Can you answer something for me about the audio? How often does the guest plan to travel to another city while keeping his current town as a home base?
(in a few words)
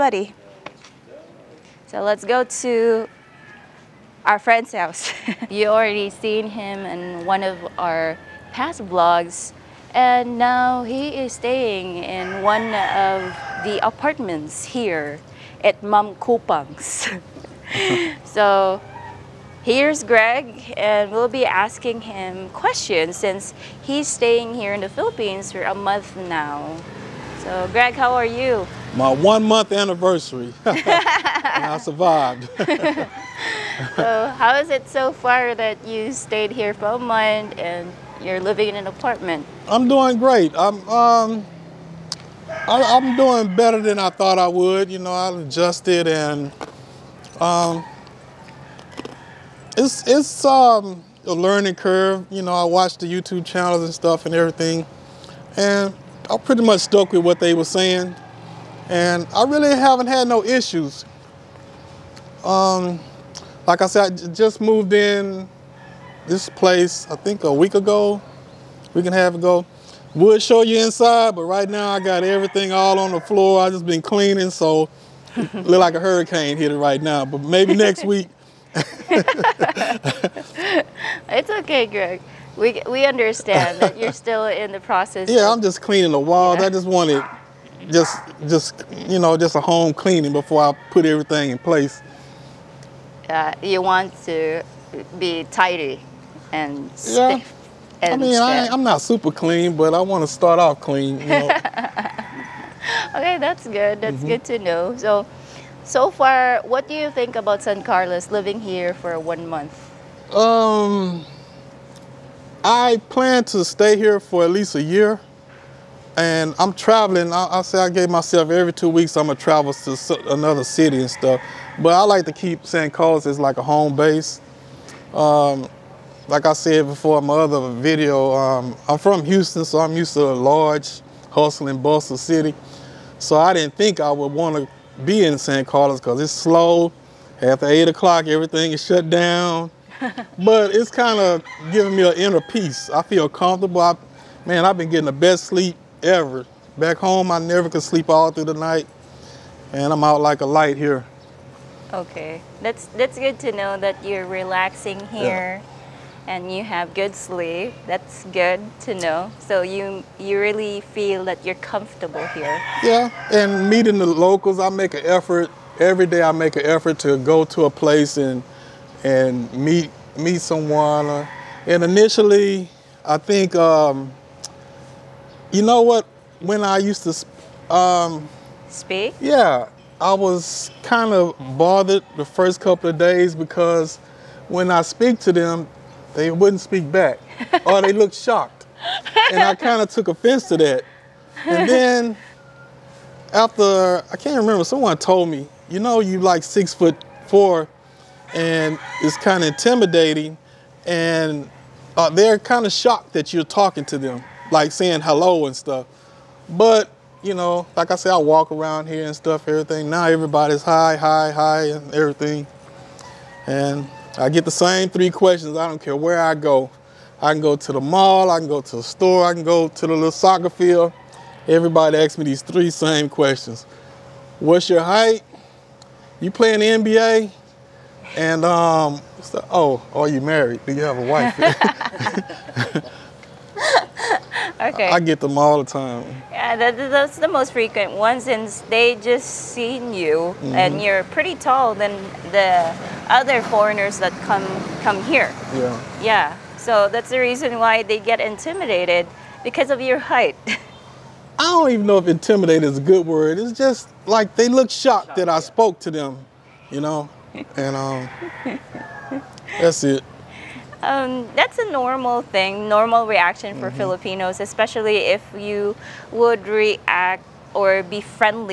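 every two weeks.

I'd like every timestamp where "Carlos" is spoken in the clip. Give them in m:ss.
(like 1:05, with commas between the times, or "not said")
1:47, 2:02, 2:15.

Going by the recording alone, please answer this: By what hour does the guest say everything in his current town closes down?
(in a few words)
8 o'clock.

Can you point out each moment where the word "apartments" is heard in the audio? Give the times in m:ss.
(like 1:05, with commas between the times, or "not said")
0:13, 0:38.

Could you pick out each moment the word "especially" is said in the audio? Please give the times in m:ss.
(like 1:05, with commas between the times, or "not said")
4:24.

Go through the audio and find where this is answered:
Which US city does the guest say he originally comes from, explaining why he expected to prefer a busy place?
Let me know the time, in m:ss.
2:09.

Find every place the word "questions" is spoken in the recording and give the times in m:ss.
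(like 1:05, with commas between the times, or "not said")
0:22, 3:35, 3:43.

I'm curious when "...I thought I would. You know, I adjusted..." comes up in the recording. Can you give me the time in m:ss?
0:43.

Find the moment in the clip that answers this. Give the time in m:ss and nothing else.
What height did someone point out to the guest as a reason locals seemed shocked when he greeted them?
3:16.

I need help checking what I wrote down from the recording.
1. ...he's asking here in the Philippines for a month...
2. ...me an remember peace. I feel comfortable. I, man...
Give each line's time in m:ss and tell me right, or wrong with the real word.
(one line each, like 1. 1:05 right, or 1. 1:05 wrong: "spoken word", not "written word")
1. 0:23 wrong: "staying", not "asking"
2. 2:21 wrong: "inner", not "remember".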